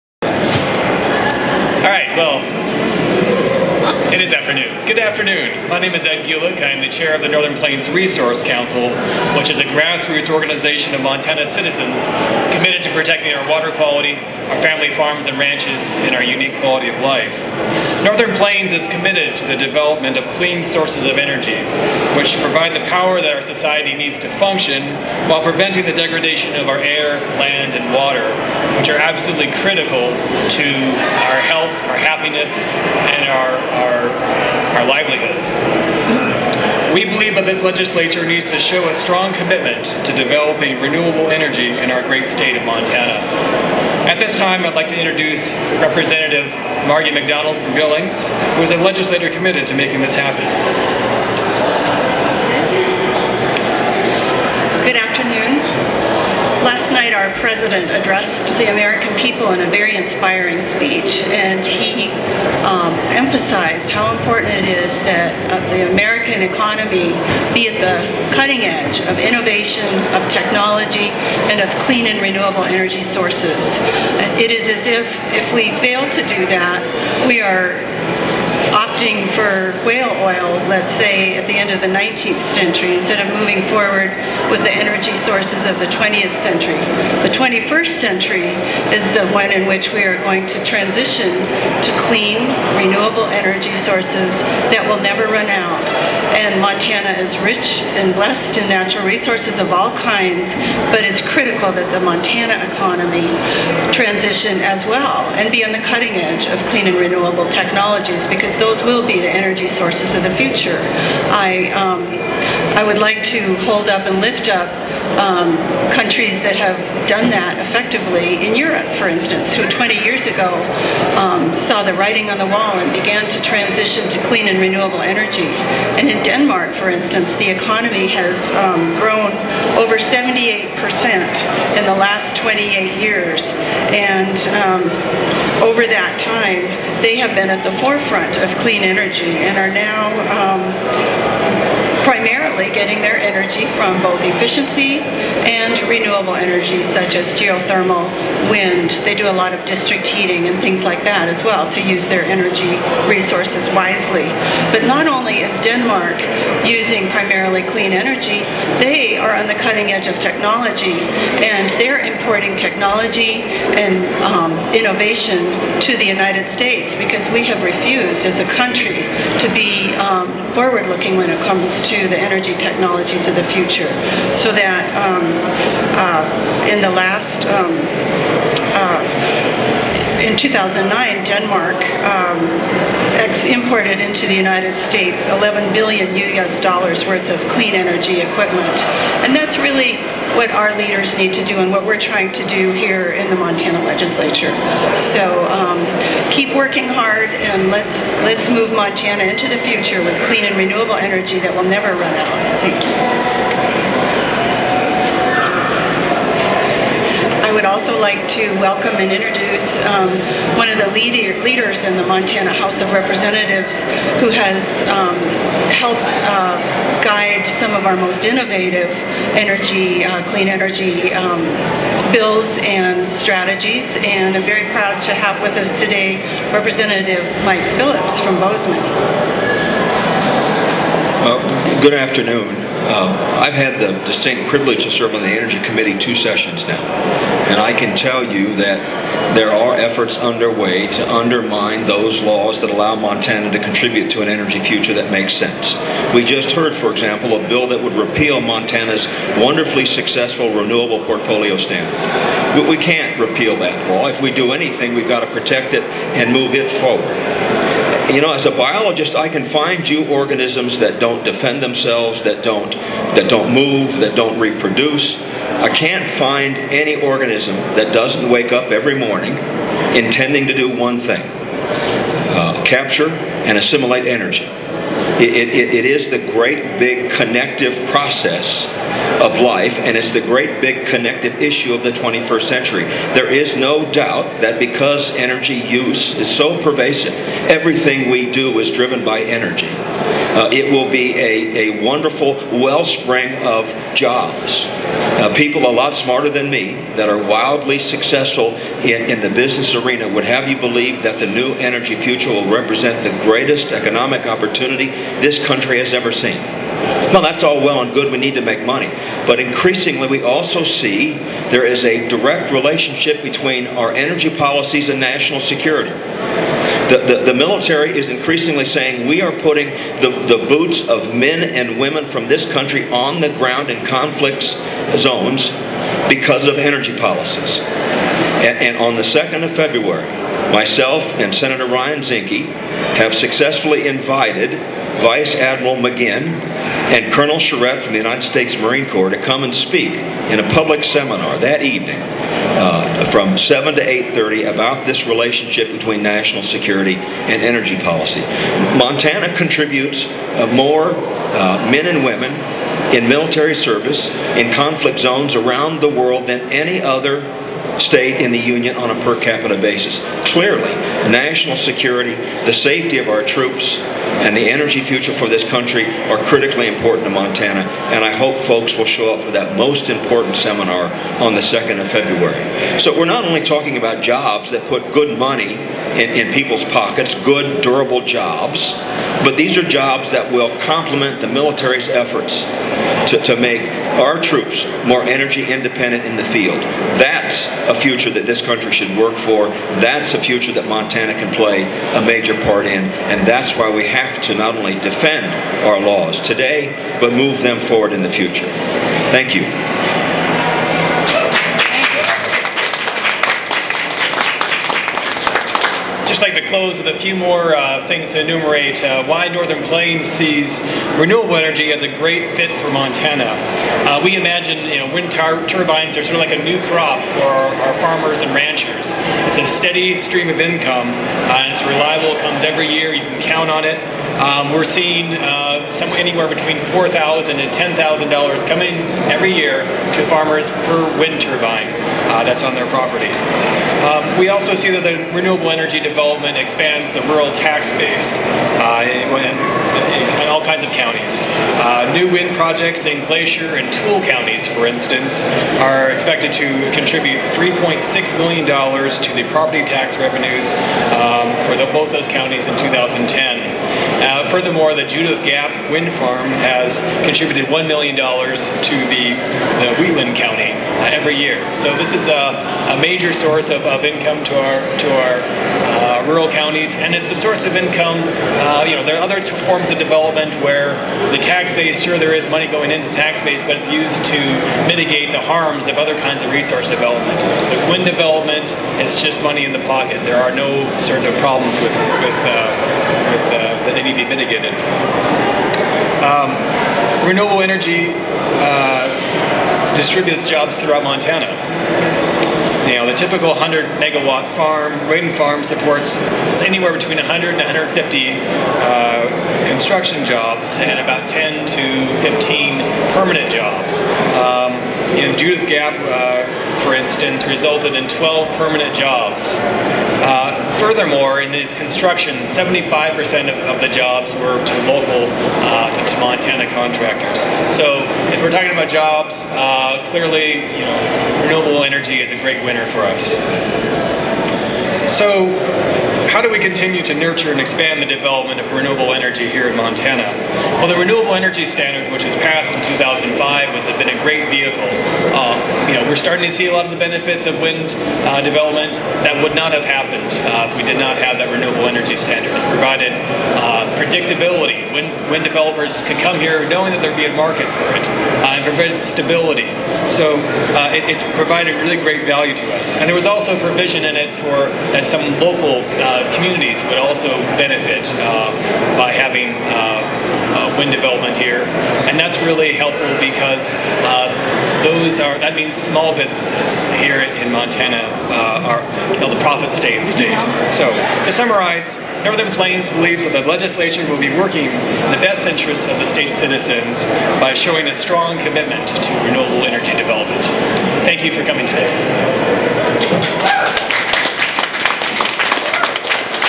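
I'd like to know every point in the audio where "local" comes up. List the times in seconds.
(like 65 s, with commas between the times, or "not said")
514 s, 555 s.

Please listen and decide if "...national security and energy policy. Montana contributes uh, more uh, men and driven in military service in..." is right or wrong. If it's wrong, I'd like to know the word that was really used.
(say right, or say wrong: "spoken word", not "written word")
wrong: "women", not "driven".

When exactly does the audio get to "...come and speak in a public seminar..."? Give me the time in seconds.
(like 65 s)
339 s.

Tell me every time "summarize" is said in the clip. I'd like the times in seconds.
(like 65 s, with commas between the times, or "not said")
571 s.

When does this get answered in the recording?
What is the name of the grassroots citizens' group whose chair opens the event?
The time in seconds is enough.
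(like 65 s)
7 s.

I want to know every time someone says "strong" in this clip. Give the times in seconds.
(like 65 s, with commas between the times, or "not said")
38 s, 577 s.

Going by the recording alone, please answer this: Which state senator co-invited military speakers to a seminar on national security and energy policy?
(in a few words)
Ryan Zinke.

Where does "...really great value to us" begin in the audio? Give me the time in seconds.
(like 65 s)
551 s.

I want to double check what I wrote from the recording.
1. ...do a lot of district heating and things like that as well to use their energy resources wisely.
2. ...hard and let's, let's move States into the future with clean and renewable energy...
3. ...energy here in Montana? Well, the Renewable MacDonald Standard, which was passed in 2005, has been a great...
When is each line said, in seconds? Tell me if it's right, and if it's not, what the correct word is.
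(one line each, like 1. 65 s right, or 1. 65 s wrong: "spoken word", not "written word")
1. 149 s right
2. 196 s wrong: "Montana", not "States"
3. 528 s wrong: "Energy", not "MacDonald".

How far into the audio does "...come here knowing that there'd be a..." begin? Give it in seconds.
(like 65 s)
545 s.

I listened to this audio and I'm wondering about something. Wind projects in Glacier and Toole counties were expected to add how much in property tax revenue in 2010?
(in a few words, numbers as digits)
$3.6 million.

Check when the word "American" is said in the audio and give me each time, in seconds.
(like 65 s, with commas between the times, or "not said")
58 s, 65 s.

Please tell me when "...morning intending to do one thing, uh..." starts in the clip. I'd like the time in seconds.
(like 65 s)
268 s.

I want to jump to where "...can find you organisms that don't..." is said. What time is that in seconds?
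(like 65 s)
259 s.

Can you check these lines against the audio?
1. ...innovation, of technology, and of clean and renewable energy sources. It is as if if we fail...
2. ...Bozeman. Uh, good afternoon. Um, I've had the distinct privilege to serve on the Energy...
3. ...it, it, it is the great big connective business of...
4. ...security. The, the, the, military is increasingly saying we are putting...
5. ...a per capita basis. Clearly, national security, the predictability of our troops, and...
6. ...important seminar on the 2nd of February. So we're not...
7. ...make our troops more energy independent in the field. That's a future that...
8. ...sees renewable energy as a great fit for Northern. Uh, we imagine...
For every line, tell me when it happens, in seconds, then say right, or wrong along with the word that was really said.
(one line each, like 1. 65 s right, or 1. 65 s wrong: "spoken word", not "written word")
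1. 69 s right
2. 228 s right
3. 275 s wrong: "process", not "business"
4. 315 s right
5. 358 s wrong: "safety", not "predictability"
6. 369 s right
7. 383 s right
8. 410 s wrong: "Montana", not "Northern".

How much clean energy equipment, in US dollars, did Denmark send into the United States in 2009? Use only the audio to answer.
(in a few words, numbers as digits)
11 billion US dollars.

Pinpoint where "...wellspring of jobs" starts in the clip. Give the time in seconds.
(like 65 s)
292 s.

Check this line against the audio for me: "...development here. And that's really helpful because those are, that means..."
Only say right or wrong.
right.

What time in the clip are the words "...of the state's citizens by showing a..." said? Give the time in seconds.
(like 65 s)
575 s.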